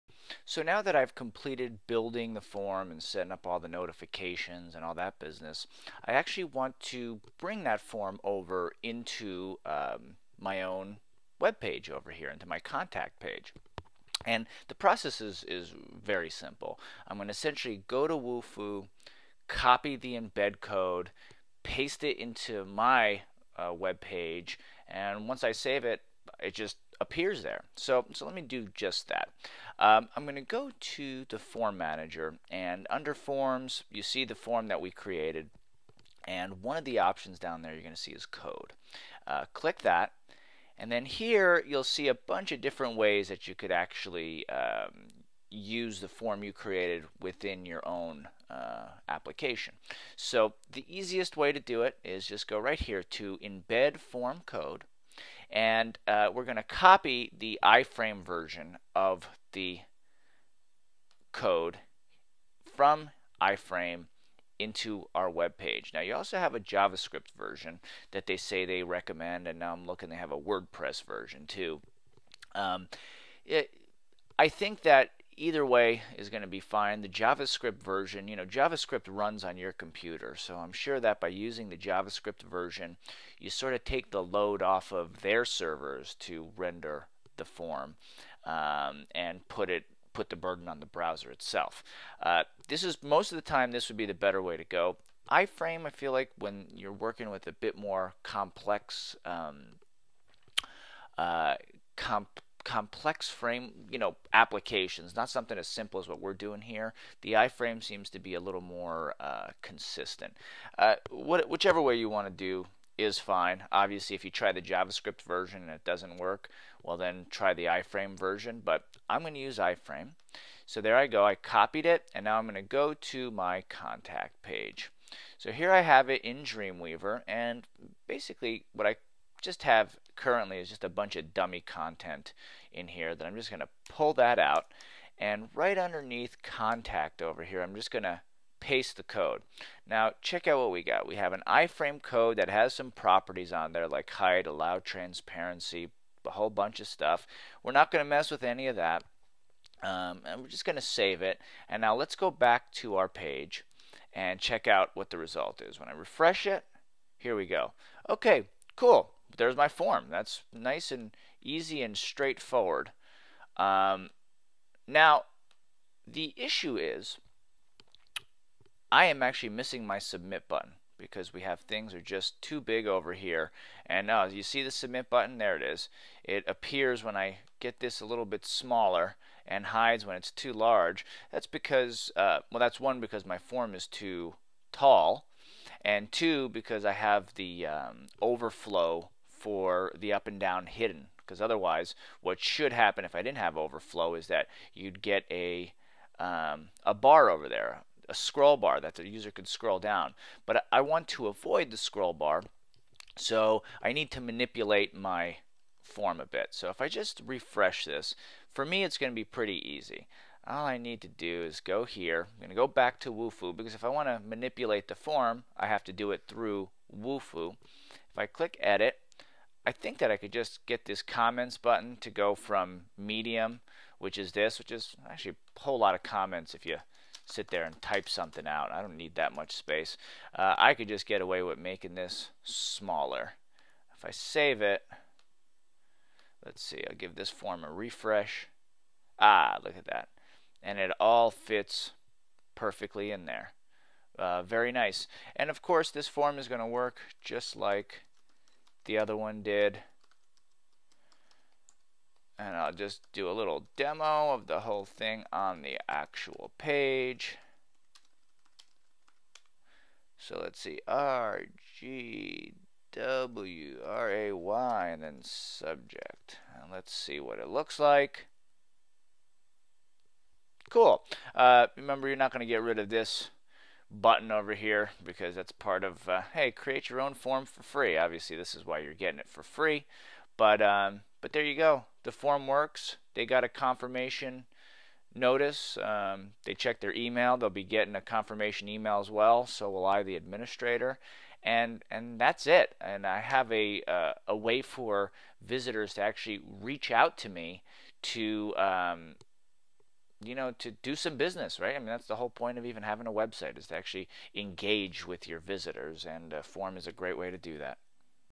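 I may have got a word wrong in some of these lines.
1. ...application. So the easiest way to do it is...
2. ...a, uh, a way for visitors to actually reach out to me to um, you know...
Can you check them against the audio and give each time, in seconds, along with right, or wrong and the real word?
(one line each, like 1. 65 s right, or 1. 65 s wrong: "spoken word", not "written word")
1. 49 s right
2. 293 s right.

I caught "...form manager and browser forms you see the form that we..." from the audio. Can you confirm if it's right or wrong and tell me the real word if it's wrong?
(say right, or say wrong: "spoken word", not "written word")
wrong: "under", not "browser".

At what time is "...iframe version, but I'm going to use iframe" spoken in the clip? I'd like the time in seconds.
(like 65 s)
117 s.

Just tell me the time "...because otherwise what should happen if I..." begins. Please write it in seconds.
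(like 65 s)
191 s.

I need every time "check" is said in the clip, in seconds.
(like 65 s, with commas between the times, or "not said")
140 s, 154 s, 286 s.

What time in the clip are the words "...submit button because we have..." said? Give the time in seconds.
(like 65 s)
169 s.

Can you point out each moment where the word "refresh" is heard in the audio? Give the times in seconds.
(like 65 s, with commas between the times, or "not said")
155 s, 207 s, 237 s.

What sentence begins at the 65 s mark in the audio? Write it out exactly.
Now you also have a JavaScript version that they say they recommend and now I'm looking they have a WordPress version too.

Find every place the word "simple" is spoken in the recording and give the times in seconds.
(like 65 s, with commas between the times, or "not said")
16 s, 105 s.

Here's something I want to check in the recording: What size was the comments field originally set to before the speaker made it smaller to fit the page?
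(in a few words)
medium.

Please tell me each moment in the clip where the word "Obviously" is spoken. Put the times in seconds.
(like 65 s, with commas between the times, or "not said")
113 s, 277 s.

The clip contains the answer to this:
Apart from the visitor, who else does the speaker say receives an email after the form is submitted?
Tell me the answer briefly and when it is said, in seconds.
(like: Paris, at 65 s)
the administrator, at 290 s.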